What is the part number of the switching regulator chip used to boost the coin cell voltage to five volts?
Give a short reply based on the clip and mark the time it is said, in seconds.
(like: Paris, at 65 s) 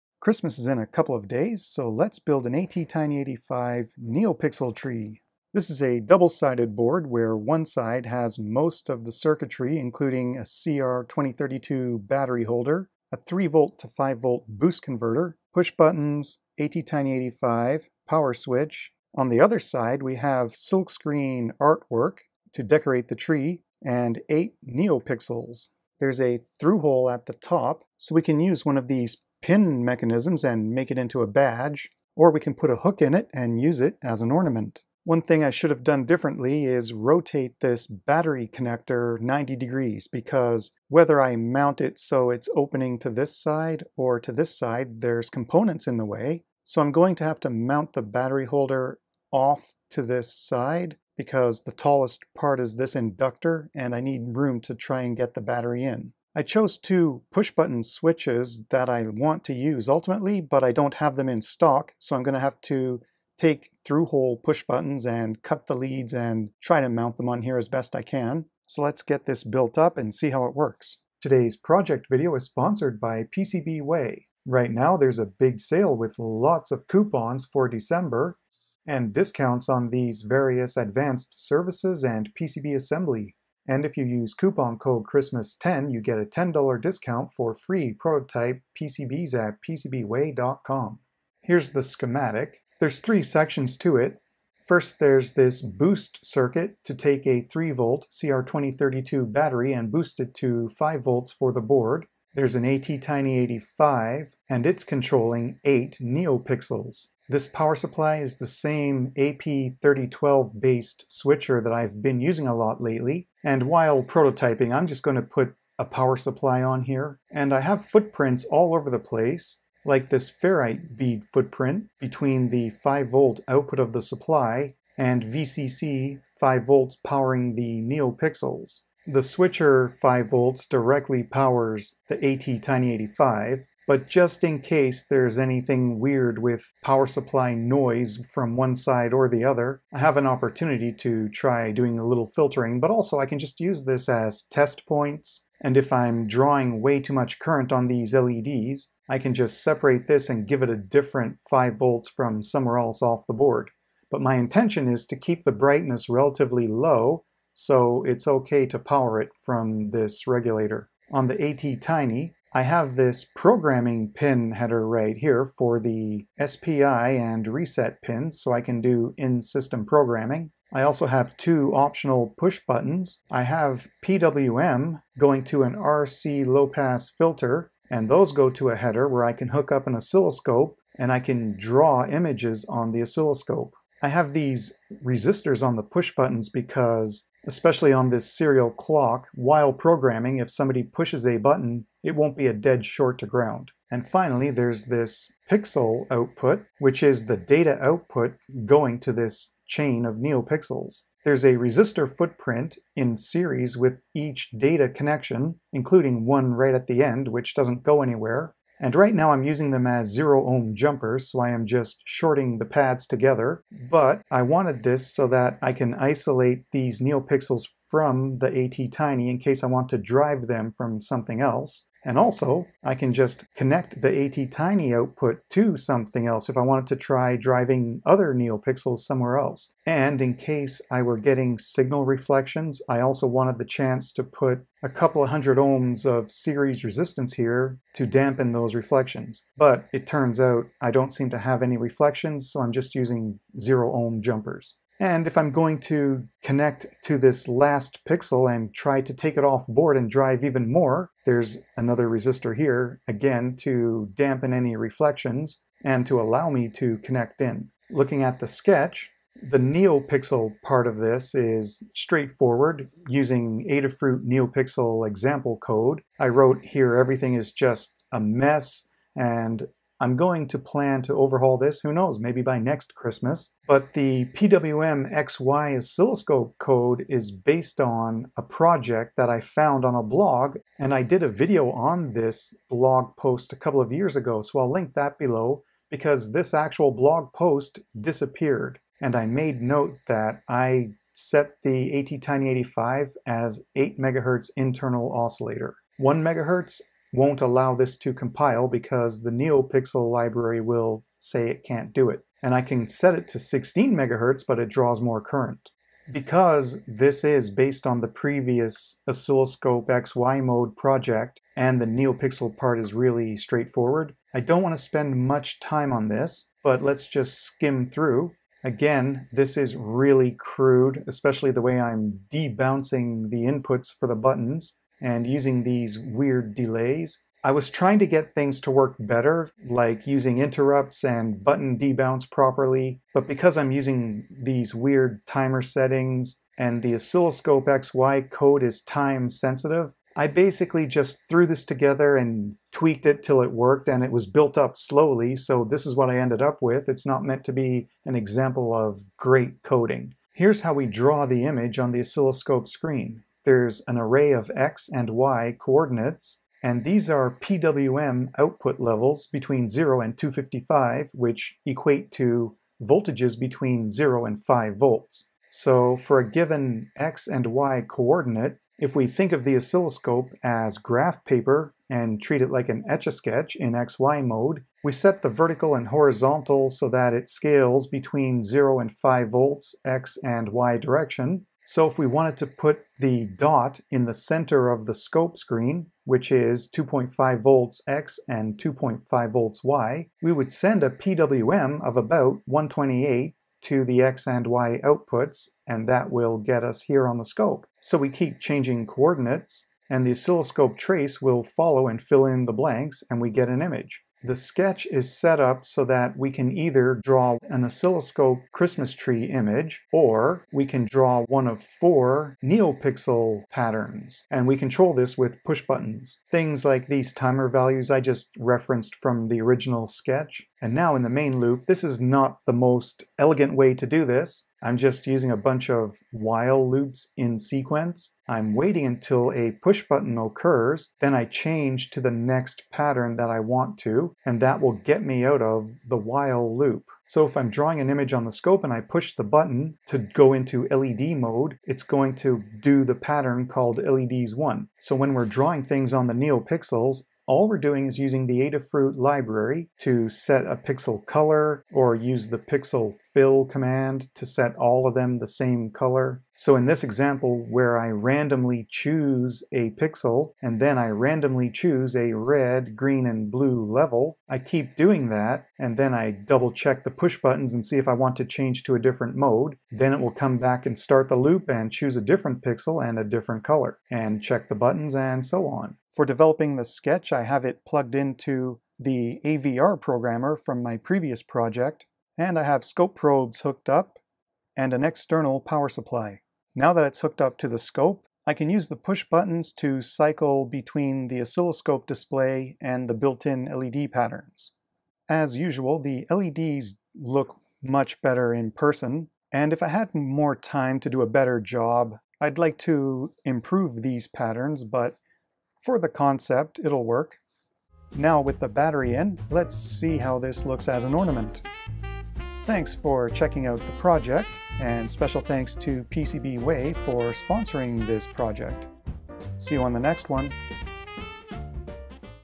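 AP3012, at 109 s.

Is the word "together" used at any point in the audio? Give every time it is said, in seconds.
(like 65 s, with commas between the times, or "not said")
213 s, 341 s.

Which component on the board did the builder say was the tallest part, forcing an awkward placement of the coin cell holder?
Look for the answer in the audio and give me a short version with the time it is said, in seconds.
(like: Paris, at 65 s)
inductor, at 52 s.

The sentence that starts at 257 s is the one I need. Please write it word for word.
Looking at the sketch, the NeoPixel part of this is straightforward using Adafruit NeoPixel example code.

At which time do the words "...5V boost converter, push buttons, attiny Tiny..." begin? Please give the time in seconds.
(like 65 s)
13 s.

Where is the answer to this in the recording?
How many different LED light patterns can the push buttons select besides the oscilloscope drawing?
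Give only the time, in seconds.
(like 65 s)
411 s.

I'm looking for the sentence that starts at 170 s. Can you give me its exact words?
I also have two optional push buttons.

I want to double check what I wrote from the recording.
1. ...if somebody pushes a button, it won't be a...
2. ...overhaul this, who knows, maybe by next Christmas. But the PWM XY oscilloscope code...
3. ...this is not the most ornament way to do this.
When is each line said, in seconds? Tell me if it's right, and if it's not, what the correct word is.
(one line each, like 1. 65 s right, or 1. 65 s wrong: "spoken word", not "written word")
1. 190 s right
2. 271 s right
3. 421 s wrong: "elegant", not "ornament".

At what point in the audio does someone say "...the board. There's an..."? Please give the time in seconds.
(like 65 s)
101 s.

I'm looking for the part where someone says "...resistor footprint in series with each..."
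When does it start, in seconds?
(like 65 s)
201 s.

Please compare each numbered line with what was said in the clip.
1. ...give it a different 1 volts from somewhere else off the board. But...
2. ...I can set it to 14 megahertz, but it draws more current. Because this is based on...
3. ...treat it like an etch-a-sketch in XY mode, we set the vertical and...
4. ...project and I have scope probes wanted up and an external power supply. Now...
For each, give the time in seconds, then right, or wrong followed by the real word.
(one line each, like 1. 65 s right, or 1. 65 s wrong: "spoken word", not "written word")
1. 150 s wrong: "5", not "1"
2. 302 s wrong: "16", not "14"
3. 372 s right
4. 481 s wrong: "hooked", not "wanted".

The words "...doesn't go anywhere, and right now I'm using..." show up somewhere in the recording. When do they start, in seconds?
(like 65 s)
207 s.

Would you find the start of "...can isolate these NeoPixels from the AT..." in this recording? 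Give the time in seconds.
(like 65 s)
215 s.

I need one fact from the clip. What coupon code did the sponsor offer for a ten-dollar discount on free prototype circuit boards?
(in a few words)
Christmas10.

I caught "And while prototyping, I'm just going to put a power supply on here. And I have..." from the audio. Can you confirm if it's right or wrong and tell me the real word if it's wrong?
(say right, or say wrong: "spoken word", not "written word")
right.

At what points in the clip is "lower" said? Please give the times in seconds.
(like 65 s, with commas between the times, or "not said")
not said.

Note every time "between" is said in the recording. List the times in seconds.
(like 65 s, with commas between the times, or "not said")
122 s, 359 s, 363 s, 377 s, 490 s.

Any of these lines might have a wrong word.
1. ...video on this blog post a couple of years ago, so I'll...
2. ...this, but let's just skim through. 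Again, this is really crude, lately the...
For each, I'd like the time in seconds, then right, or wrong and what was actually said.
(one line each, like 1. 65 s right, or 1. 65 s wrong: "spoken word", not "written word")
1. 281 s right
2. 316 s wrong: "especially", not "lately".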